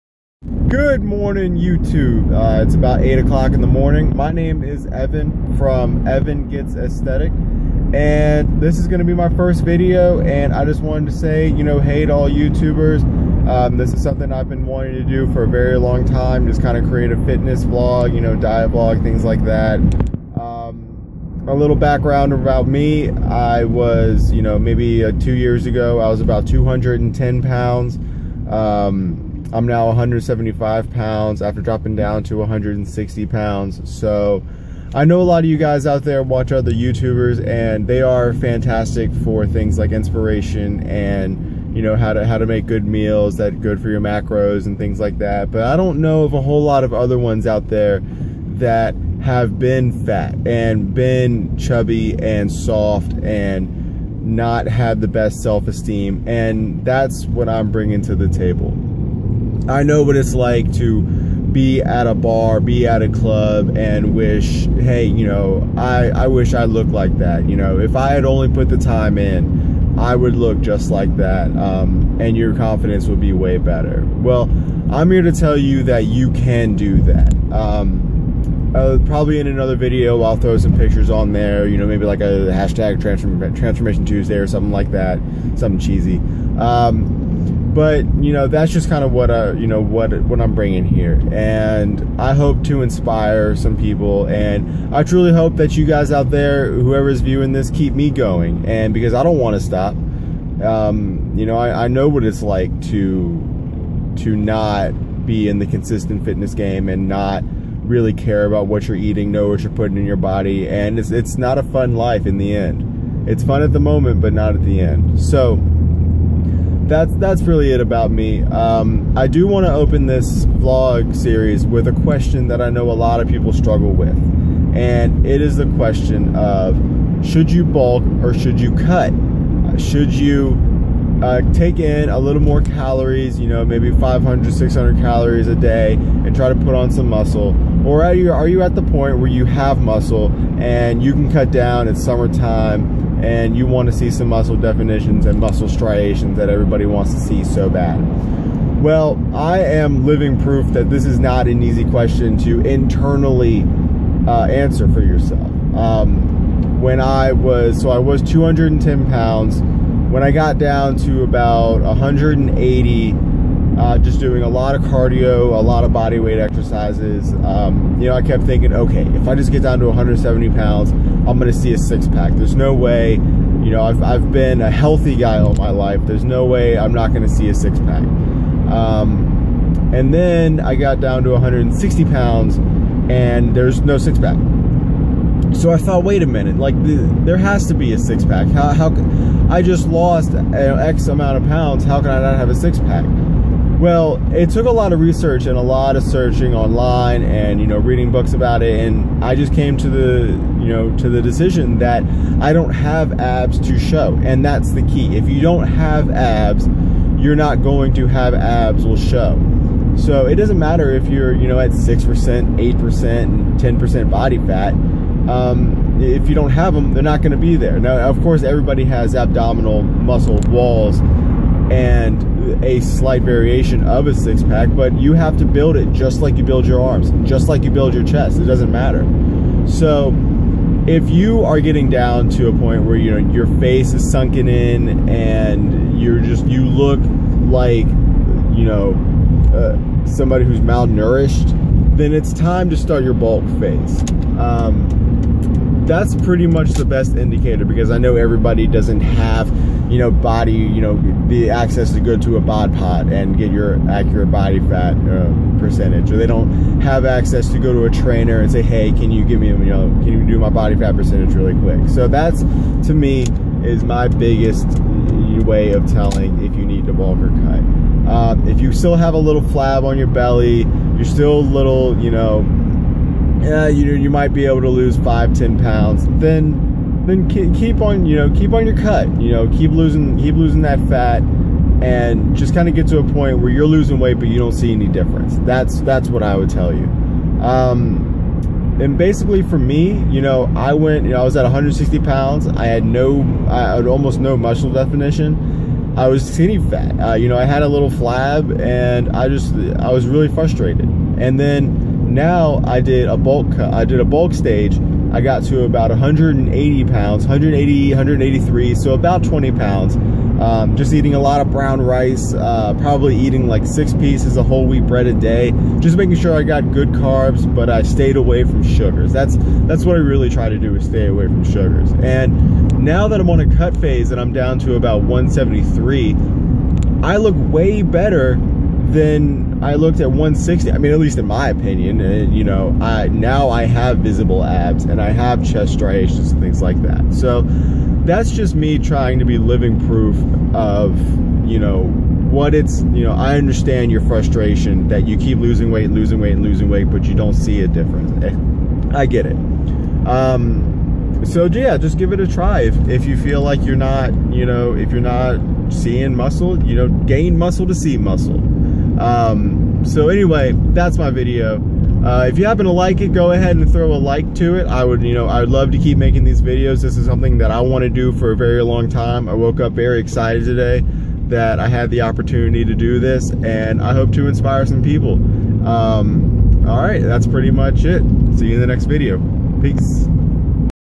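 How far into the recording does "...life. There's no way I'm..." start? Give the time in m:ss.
2:55.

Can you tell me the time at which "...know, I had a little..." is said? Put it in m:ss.
4:57.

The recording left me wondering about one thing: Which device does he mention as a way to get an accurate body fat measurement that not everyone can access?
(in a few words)
bod pod.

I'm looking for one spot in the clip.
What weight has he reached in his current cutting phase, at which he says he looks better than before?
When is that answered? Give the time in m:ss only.
5:25.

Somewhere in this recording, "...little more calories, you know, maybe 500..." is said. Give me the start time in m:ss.
2:12.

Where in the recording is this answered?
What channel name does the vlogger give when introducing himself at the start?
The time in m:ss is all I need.
0:06.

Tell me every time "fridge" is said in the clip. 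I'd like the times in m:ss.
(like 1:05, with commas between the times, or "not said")
not said.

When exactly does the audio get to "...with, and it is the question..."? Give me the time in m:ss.
2:03.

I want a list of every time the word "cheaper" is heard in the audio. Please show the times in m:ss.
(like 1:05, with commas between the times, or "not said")
not said.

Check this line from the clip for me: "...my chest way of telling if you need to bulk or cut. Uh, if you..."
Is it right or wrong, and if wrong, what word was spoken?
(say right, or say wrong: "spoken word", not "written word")
wrong: "biggest", not "chest".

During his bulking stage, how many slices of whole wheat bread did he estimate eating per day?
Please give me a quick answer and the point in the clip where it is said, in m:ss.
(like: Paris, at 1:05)
6, at 5:13.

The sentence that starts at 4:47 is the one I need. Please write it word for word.
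Um, and basically for me, you know, I went, you know, I was at 160 pounds.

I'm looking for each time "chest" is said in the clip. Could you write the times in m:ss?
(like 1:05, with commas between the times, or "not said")
3:48, 5:35.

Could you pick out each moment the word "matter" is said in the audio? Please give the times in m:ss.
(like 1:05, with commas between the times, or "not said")
3:30, 3:48.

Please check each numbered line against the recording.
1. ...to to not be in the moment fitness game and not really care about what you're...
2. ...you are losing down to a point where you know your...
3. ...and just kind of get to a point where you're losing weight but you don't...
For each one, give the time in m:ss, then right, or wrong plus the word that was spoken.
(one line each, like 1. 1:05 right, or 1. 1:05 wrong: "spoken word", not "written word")
1. 1:42 wrong: "consistent", not "moment"
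2. 3:51 wrong: "getting", not "losing"
3. 4:41 right.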